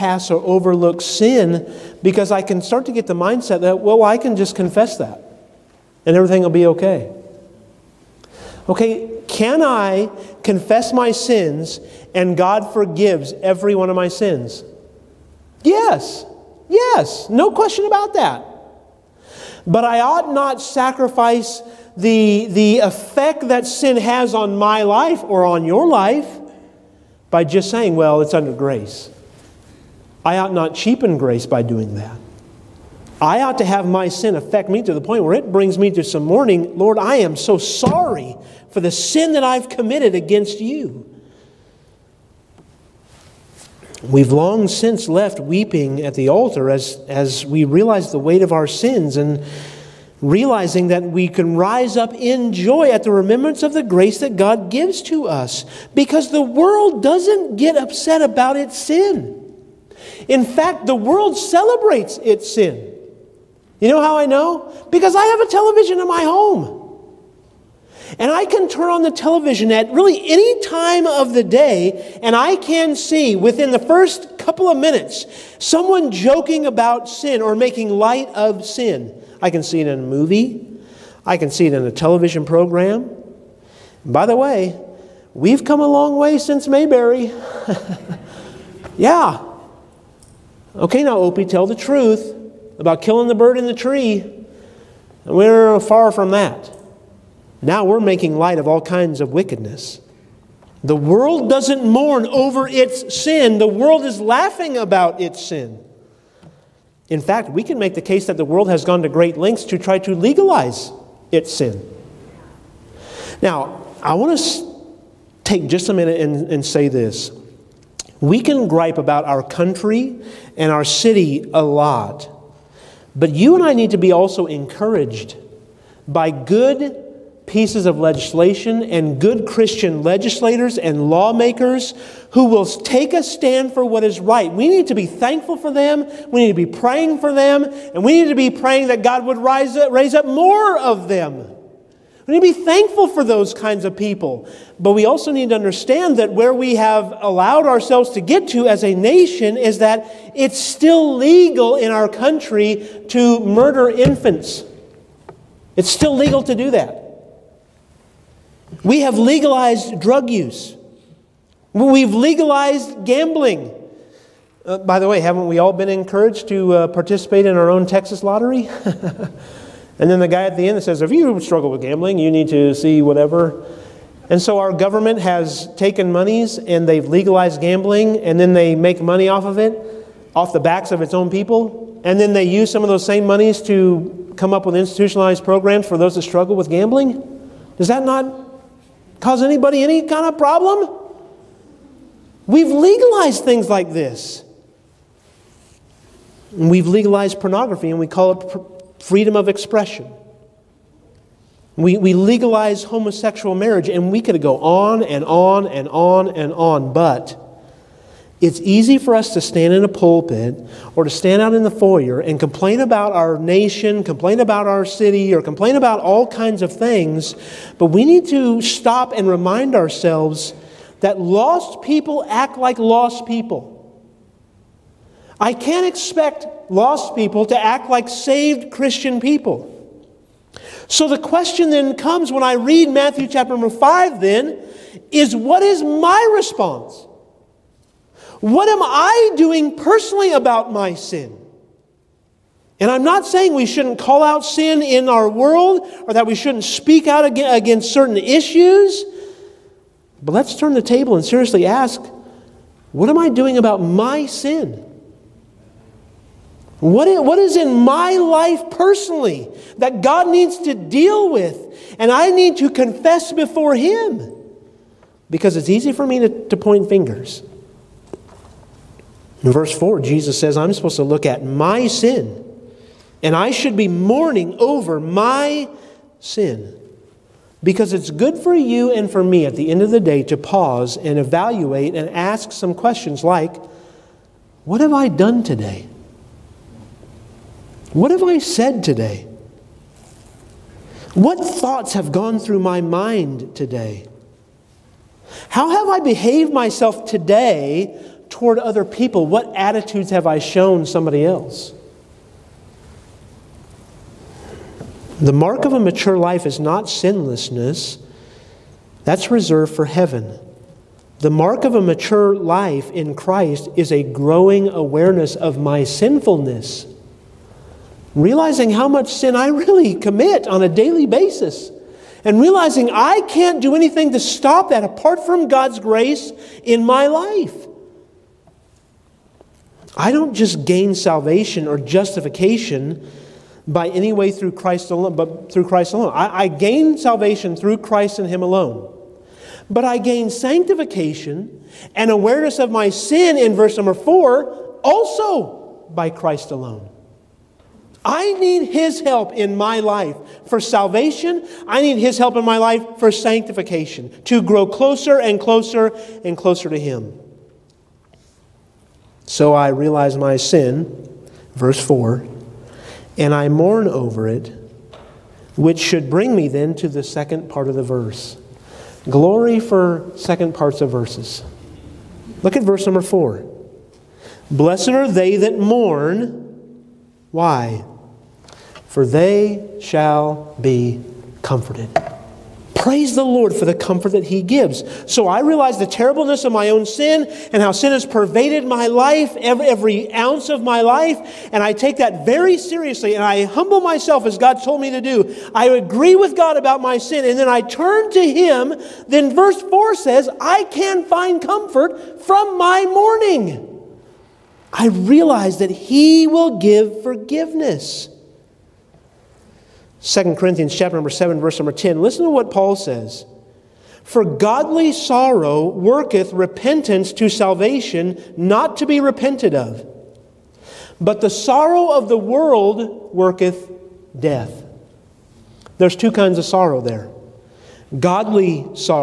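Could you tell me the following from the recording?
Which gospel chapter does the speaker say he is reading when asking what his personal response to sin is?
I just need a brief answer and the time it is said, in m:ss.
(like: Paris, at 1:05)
Matthew 5, at 3:52.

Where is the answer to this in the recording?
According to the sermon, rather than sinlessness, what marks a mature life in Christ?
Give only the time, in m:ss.
5:14.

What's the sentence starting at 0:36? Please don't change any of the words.
Lord, I am so sorry for the sin that I've committed against you.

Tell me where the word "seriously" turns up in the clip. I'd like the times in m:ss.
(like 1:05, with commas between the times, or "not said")
4:11, 6:32.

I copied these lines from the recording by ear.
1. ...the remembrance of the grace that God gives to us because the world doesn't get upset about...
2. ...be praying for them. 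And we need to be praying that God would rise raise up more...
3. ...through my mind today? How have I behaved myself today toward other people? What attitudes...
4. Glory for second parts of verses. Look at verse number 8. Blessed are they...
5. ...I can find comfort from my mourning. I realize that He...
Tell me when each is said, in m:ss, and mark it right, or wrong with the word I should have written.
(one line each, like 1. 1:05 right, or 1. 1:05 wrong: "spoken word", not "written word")
1. 0:53 right
2. 2:16 right
3. 4:52 right
4. 6:09 wrong: "4", not "8"
5. 6:40 right.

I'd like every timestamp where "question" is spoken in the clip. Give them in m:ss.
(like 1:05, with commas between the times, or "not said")
0:17, 3:51, 4:42.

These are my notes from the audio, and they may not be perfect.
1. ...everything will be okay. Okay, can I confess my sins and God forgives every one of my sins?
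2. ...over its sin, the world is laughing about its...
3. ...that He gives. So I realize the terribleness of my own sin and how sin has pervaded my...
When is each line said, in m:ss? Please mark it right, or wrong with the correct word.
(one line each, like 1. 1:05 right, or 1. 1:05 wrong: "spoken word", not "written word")
1. 0:06 right
2. 1:42 right
3. 6:24 right.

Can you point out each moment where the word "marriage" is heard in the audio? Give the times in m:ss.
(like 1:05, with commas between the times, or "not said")
3:23.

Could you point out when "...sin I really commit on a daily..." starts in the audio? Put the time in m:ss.
5:19.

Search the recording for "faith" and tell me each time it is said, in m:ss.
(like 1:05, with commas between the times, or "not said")
not said.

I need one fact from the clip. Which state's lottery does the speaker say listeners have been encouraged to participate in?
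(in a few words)
Texas.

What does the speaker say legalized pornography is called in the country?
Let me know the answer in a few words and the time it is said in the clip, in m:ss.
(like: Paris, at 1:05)
freedom of expression, at 3:19.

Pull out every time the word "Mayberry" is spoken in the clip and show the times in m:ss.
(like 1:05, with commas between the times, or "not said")
1:26.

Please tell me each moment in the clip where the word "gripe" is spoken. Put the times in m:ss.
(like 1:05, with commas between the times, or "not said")
1:58.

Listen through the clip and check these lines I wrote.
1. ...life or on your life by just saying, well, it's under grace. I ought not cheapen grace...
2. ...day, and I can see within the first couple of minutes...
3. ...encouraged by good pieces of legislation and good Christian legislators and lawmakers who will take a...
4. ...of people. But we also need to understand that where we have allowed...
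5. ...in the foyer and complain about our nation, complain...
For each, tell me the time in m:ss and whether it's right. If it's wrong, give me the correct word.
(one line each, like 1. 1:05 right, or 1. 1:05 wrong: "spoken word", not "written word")
1. 0:24 right
2. 1:11 right
3. 2:04 right
4. 2:23 right
5. 3:31 right.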